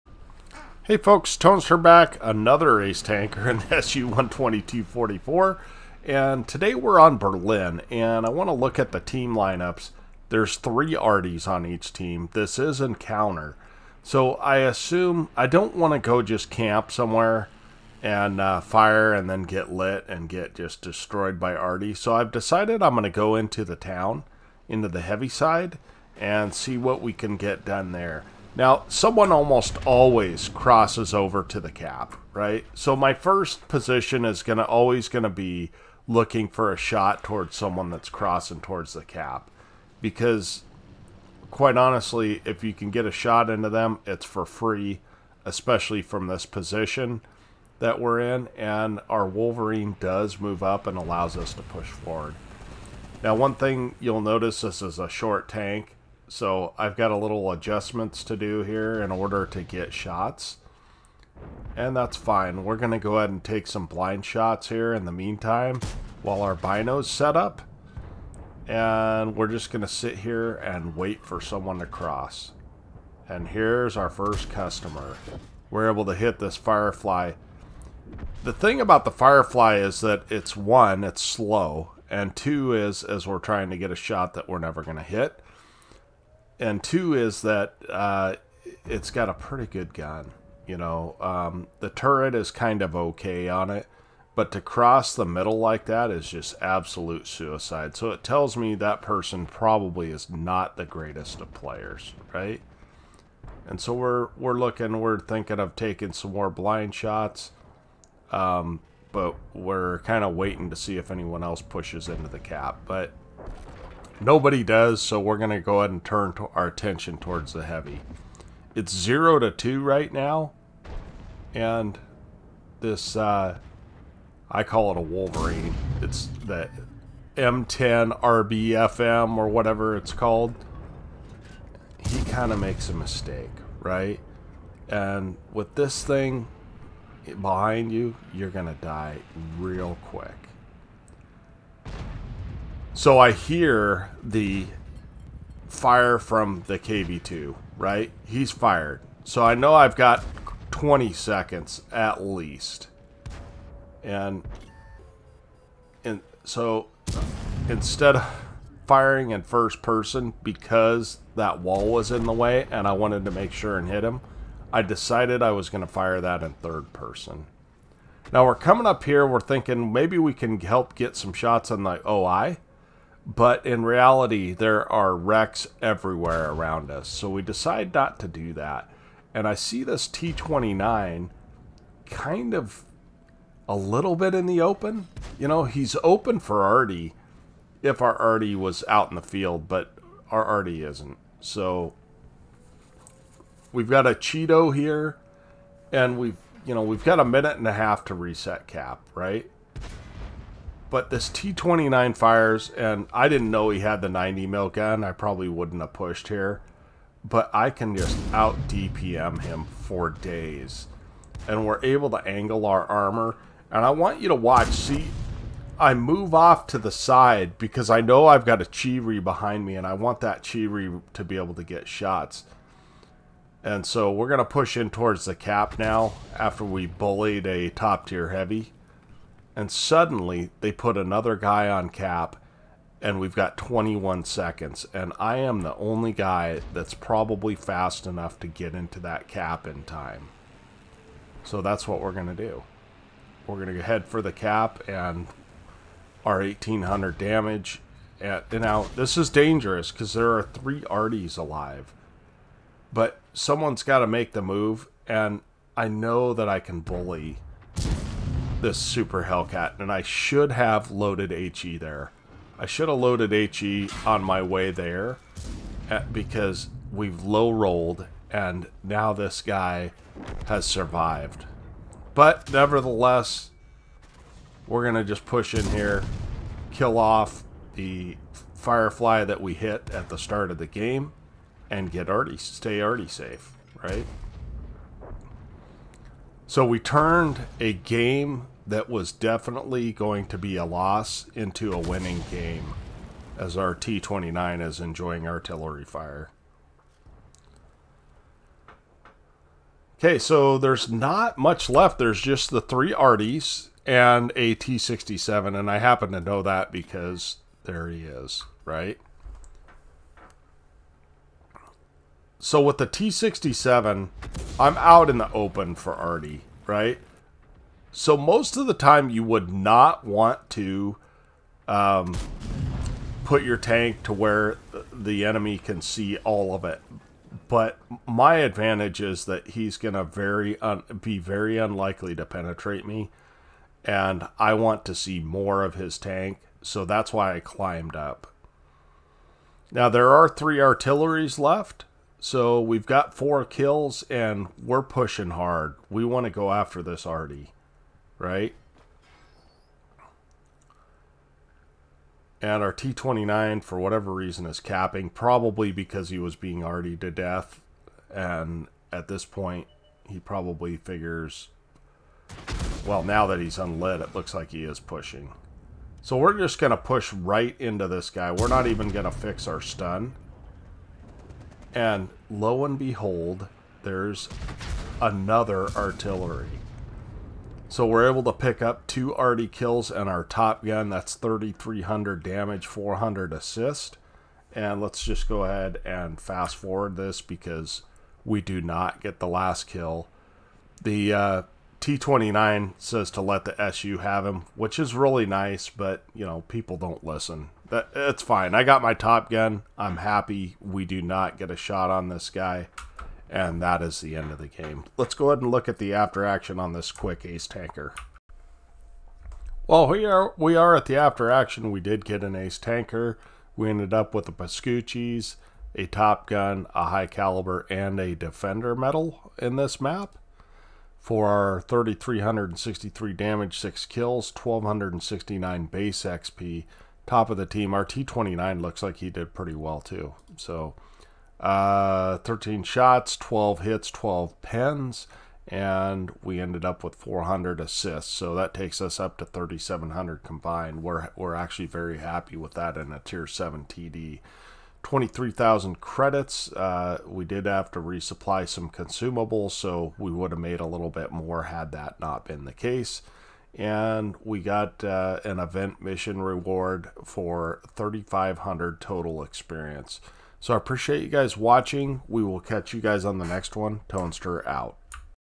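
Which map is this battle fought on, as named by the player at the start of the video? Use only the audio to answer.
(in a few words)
Berlin.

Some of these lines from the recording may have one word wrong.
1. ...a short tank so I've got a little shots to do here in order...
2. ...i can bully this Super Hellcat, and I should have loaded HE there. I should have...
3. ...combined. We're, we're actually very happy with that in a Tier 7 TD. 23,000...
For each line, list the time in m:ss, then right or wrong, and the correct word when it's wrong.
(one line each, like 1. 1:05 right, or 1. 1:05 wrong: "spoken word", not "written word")
1. 0:54 wrong: "adjustments", not "shots"
2. 4:16 right
3. 7:20 right.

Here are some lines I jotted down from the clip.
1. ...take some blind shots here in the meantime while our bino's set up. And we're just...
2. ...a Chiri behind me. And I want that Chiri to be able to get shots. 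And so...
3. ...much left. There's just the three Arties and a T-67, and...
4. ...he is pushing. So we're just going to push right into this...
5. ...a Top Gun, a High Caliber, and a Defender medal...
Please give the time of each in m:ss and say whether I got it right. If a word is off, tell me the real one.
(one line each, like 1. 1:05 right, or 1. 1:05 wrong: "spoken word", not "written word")
1. 1:03 right
2. 3:38 right
3. 5:01 right
4. 6:04 right
5. 6:55 right.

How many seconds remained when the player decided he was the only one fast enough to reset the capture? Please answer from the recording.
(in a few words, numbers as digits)
21.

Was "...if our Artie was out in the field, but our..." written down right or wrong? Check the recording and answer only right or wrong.
right.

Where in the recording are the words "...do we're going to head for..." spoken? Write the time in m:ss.
4:02.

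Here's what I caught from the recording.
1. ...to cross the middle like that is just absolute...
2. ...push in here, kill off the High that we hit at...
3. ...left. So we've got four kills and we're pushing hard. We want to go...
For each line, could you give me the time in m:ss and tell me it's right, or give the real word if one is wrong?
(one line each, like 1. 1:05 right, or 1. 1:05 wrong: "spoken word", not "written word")
1. 1:34 right
2. 4:35 wrong: "Firefly", not "High"
3. 5:41 right.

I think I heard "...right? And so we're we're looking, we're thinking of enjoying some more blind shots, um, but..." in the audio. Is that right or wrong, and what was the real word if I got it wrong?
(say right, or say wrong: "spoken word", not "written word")
wrong: "taking", not "enjoying".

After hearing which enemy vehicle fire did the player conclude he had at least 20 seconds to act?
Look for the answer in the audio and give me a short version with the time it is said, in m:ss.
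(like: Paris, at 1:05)
KV2, at 2:26.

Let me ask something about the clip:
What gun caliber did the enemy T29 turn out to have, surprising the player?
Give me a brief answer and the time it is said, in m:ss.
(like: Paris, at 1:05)
90 mm, at 3:24.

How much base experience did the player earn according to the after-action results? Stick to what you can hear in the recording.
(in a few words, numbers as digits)
1,269.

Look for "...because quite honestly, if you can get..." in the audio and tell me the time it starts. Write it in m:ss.
0:40.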